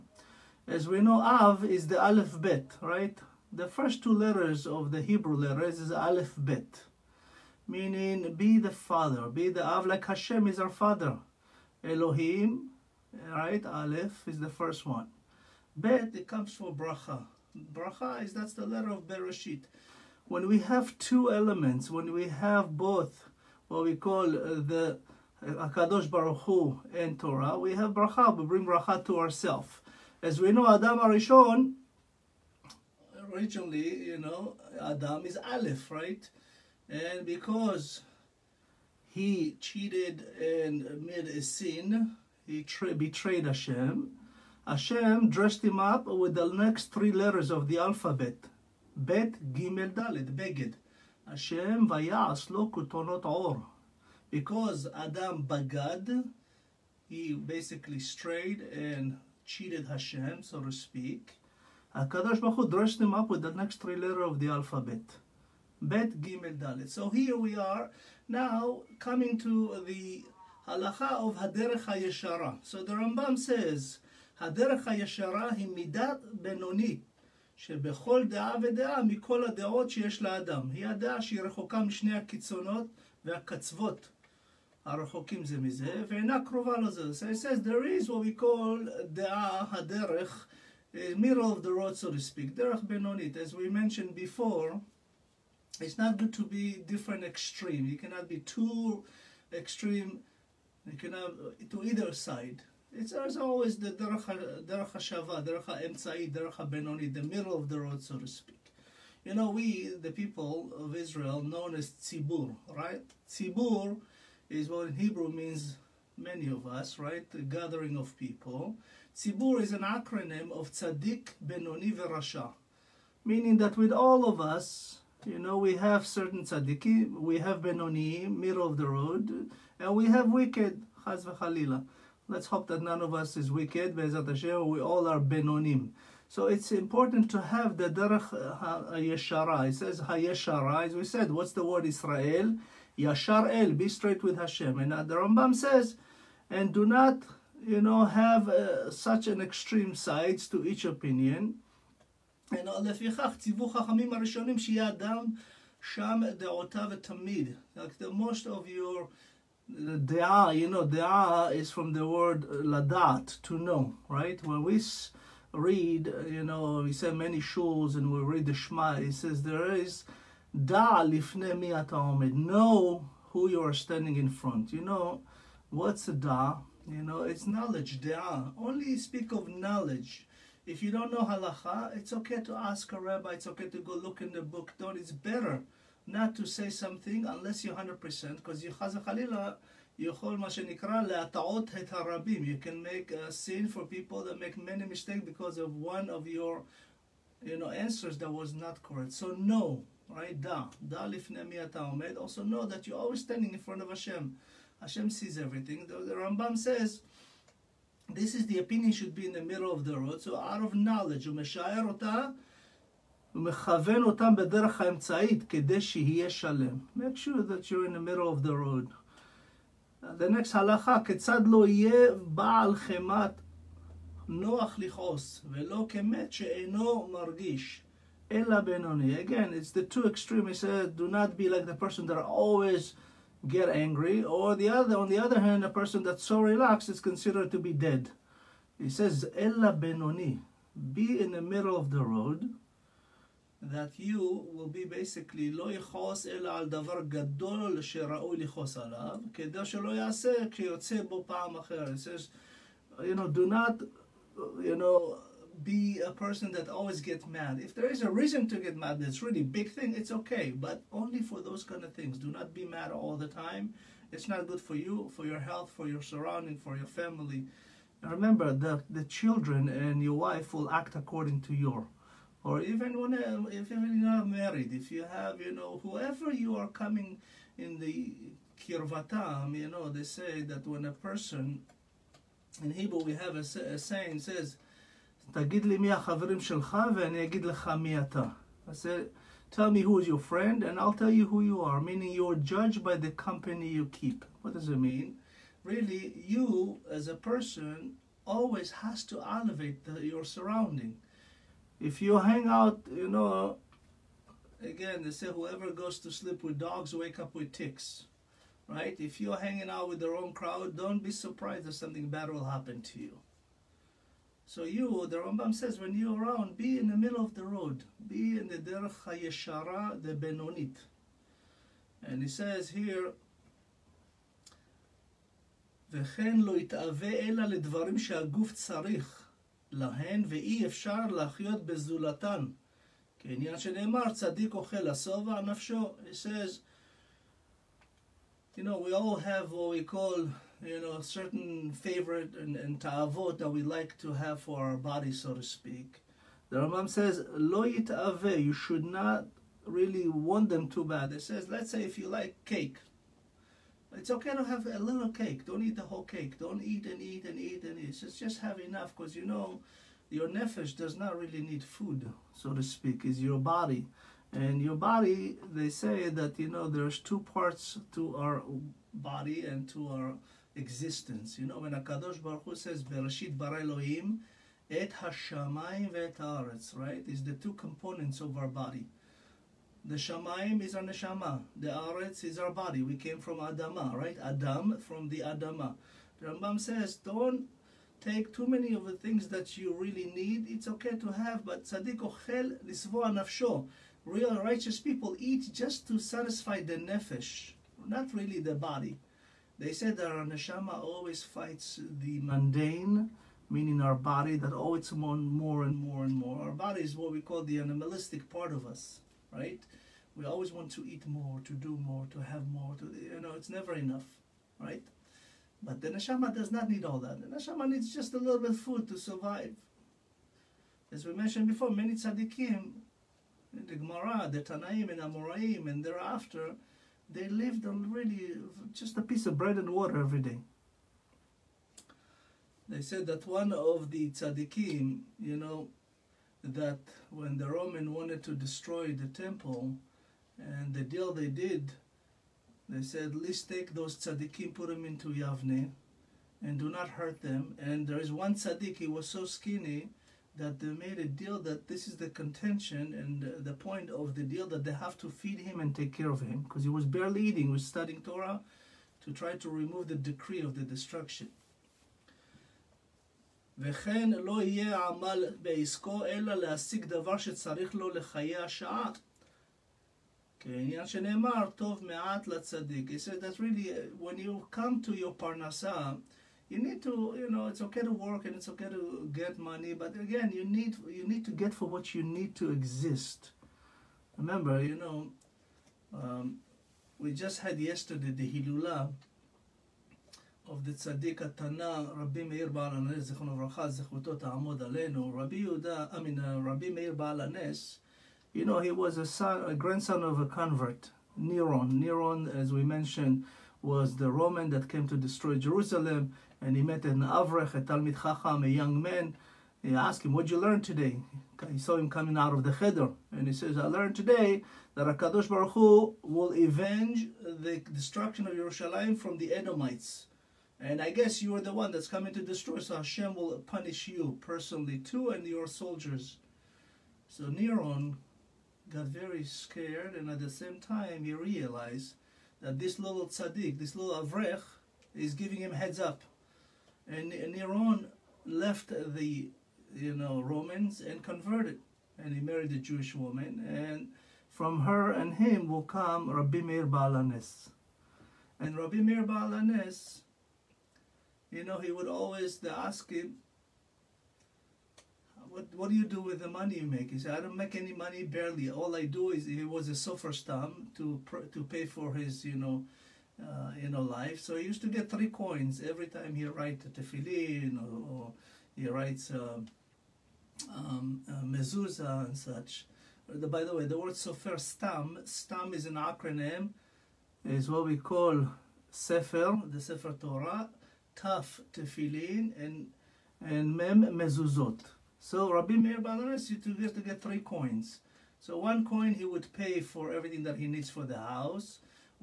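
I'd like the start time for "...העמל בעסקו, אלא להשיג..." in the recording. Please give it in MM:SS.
07:44.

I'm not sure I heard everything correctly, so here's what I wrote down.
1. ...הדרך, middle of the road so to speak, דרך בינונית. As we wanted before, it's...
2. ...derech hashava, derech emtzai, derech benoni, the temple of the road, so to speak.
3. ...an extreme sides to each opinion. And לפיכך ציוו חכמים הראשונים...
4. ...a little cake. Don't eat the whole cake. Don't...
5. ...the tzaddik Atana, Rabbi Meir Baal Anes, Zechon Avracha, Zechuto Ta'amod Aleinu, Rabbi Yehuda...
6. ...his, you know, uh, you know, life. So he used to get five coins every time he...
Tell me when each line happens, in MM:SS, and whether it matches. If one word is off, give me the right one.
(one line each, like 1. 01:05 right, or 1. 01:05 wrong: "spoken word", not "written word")
1. 01:29 wrong: "mentioned", not "wanted"
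2. 01:43 wrong: "middle", not "temple"
3. 02:29 right
4. 05:54 right
5. 08:10 right
6. 09:21 wrong: "three", not "five".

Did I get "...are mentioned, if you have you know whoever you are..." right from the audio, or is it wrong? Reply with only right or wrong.
wrong.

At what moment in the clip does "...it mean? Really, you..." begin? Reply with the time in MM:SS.
04:54.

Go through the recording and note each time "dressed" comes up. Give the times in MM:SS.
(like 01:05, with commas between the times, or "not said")
00:45, 01:02.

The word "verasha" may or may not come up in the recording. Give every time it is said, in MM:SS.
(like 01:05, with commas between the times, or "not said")
02:01.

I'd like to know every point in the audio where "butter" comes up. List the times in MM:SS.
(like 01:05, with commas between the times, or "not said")
not said.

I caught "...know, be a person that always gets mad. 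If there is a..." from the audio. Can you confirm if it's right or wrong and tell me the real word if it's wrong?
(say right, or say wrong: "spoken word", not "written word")
right.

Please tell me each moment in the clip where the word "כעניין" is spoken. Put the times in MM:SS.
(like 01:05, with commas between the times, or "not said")
05:33, 07:50.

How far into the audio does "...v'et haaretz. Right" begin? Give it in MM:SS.
06:15.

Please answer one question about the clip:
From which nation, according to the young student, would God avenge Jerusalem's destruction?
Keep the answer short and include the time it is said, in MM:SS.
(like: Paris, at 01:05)
The Edomites, at 08:39.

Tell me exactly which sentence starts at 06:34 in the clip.
Real righteous people eat just to satisfy the nefesh, not really the body.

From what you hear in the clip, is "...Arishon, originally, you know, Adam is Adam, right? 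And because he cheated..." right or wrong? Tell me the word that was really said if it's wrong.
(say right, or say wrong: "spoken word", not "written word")
wrong: "Aleph", not "Adam".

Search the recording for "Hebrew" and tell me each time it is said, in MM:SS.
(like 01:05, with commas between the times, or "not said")
00:05, 01:54, 04:42.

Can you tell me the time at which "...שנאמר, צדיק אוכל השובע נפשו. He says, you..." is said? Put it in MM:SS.
05:33.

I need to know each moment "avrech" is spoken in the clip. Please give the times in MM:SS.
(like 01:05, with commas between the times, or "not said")
08:26, 08:54.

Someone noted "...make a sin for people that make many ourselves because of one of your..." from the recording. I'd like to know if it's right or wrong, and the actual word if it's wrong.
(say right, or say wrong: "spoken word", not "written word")
wrong: "mistakes", not "ourselves".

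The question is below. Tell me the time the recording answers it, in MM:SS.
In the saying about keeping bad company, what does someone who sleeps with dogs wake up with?
05:07.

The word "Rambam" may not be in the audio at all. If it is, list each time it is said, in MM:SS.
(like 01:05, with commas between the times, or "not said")
01:12, 02:25, 03:26, 05:15, 05:46, 06:26.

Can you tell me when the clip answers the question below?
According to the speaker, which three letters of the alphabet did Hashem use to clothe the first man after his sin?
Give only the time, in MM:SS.
01:05.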